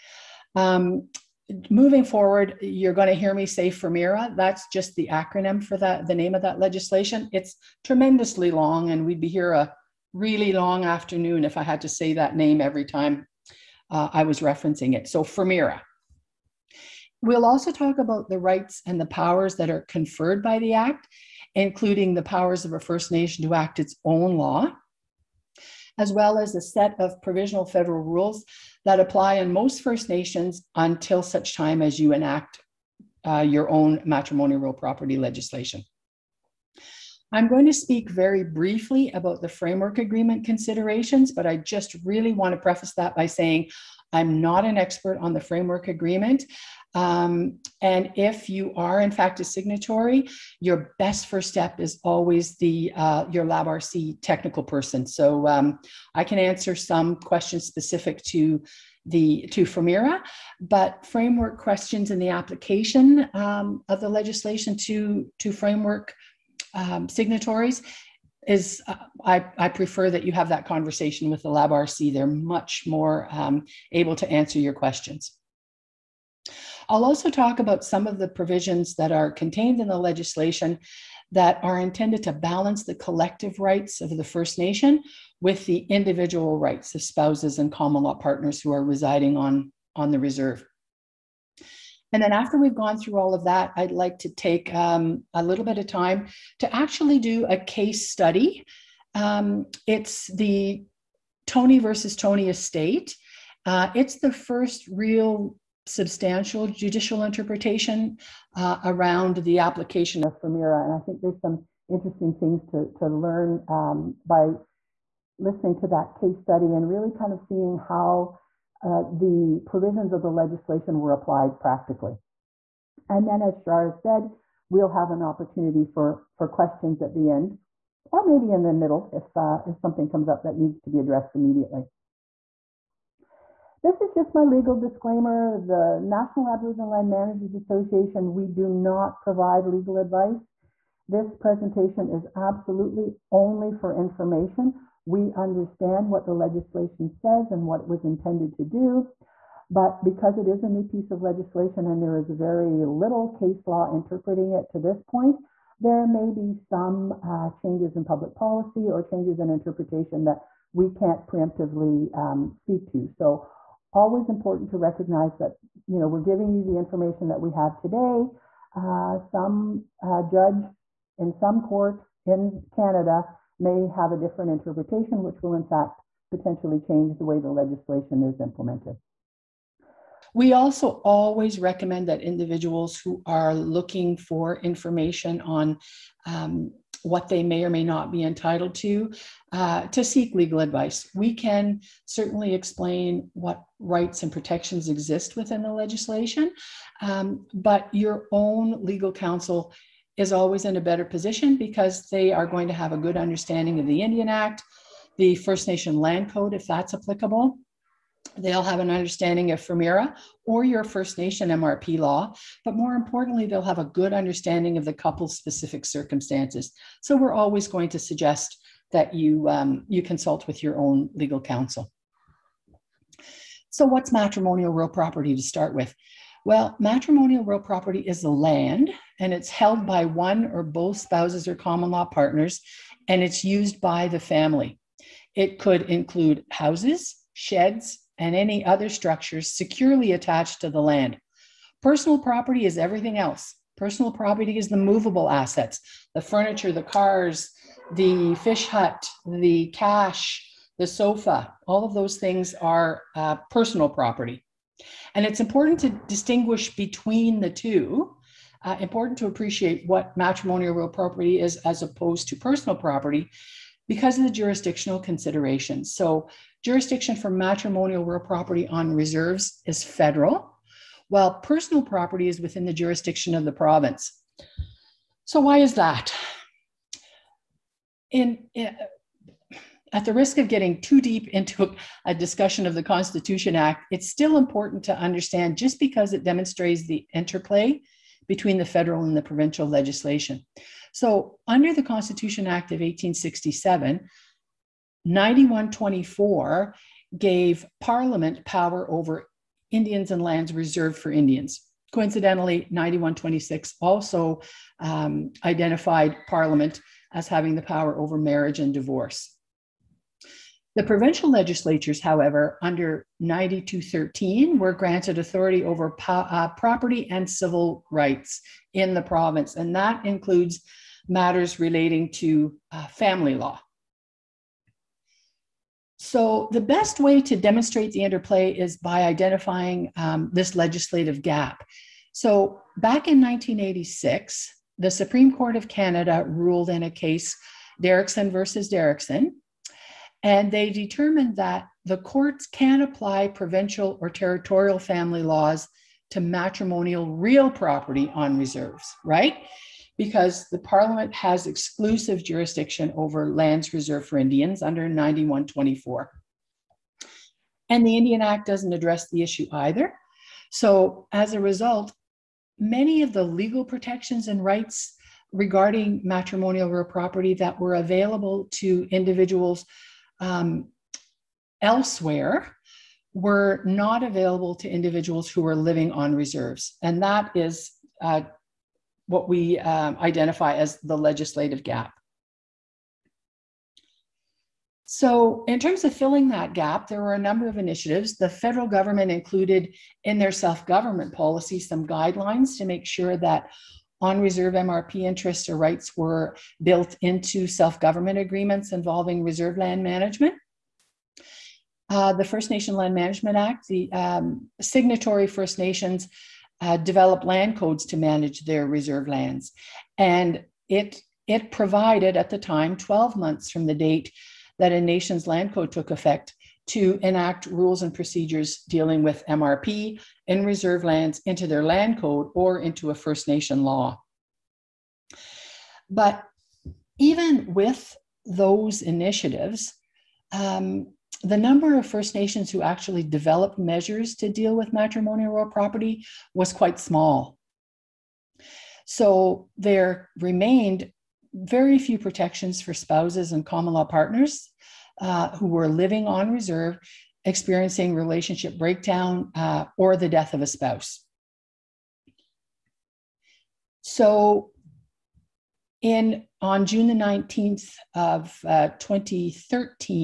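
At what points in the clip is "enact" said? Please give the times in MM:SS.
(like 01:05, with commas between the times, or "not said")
00:32, 06:57.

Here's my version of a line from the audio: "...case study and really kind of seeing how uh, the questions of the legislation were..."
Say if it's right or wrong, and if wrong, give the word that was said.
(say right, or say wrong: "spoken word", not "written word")
wrong: "provisions", not "questions".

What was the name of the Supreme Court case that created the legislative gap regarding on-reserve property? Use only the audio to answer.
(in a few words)
Derrickson versus Derrickson.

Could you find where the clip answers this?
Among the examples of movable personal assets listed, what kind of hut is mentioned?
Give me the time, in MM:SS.
04:07.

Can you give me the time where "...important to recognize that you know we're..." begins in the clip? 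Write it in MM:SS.
02:44.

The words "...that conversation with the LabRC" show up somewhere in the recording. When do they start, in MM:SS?
01:10.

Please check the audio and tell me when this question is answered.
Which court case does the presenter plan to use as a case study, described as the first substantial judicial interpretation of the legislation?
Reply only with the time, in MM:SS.
01:41.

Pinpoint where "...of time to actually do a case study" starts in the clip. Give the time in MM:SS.
01:35.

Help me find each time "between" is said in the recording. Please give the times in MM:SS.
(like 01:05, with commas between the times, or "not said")
04:16, 04:48.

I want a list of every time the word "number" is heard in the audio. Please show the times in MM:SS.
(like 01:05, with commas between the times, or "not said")
06:27, 07:11.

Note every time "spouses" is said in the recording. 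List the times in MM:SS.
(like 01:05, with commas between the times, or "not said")
01:27, 03:50, 07:22, 07:30.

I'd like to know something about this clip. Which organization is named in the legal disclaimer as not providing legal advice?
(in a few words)
National Aboriginal Land Managers Association.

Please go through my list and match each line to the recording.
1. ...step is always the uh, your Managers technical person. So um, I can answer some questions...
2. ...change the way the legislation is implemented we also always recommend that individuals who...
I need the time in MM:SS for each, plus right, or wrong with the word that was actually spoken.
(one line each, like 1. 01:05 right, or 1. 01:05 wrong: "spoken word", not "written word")
1. 00:51 wrong: "LabRC", not "Managers"
2. 02:56 right.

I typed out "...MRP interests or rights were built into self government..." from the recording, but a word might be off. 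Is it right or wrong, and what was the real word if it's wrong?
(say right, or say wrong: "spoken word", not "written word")
right.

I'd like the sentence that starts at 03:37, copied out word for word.
So we're always going to suggest that you, um, you consult with your own legal counsel.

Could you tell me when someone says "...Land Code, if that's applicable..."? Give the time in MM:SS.
03:25.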